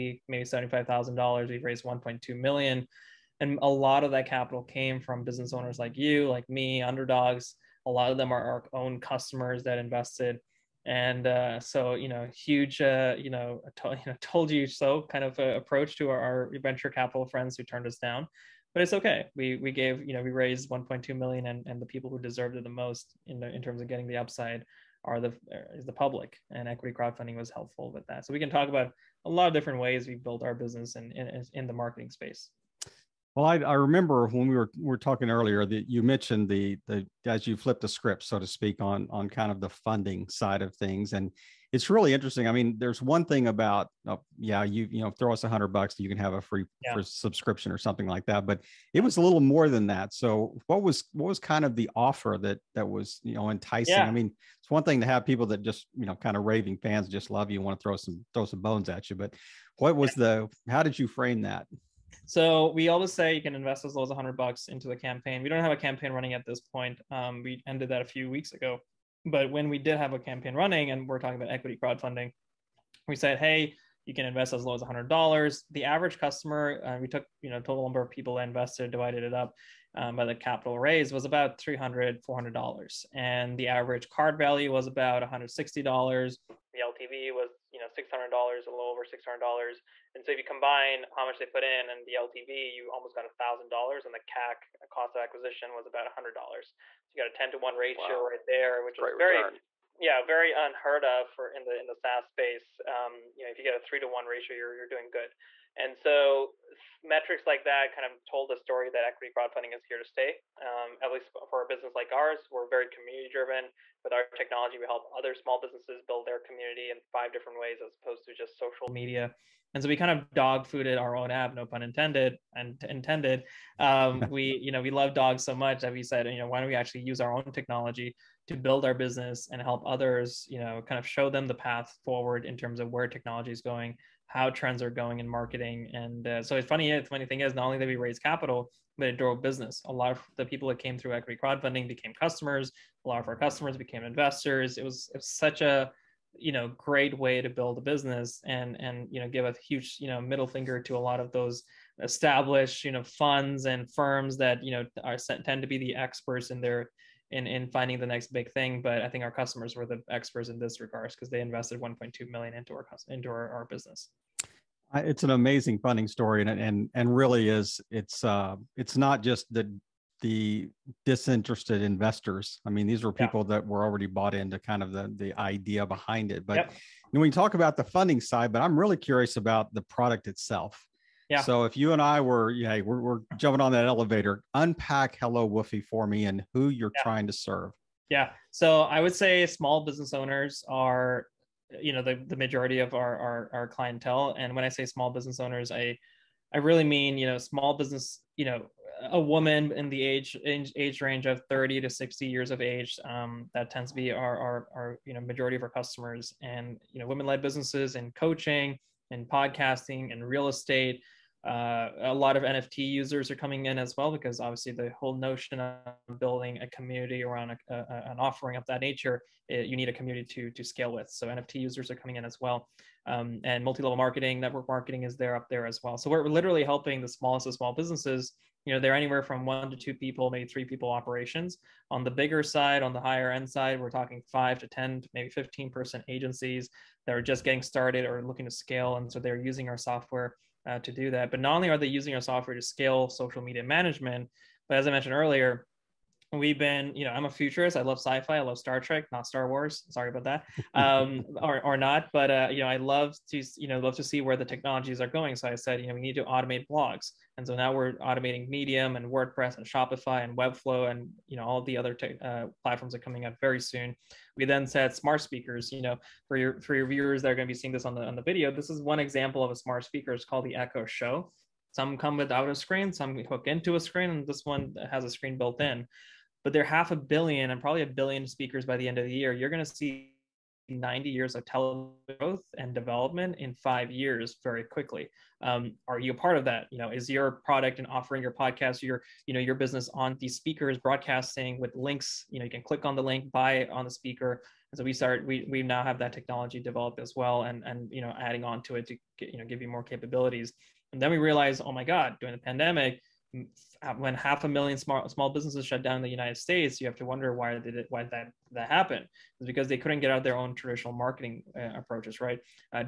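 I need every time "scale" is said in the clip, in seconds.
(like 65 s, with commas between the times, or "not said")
220 s, 238 s, 242 s.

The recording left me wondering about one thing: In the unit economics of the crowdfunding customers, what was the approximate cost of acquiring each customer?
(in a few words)
$100.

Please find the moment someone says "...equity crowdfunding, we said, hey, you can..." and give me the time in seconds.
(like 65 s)
71 s.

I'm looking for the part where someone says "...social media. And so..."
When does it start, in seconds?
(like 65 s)
118 s.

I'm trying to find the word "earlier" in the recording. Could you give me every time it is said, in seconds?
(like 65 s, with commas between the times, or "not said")
35 s, 245 s.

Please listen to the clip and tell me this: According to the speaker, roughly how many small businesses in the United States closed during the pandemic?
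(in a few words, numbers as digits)
half a million.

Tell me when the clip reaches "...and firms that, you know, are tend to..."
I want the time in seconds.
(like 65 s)
153 s.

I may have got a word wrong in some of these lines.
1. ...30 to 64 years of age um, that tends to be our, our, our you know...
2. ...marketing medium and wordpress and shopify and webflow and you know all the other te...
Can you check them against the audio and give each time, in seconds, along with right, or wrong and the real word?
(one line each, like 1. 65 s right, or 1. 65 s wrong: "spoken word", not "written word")
1. 201 s wrong: "60", not "64"
2. 257 s wrong: "automating", not "marketing".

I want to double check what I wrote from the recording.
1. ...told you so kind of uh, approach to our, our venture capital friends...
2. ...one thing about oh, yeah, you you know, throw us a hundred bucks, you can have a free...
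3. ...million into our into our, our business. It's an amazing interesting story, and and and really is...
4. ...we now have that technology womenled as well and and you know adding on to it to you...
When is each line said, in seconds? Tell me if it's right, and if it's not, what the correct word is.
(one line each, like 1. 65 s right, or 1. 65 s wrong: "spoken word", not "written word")
1. 14 s right
2. 43 s right
3. 162 s wrong: "funding", not "interesting"
4. 295 s wrong: "developed", not "womenled".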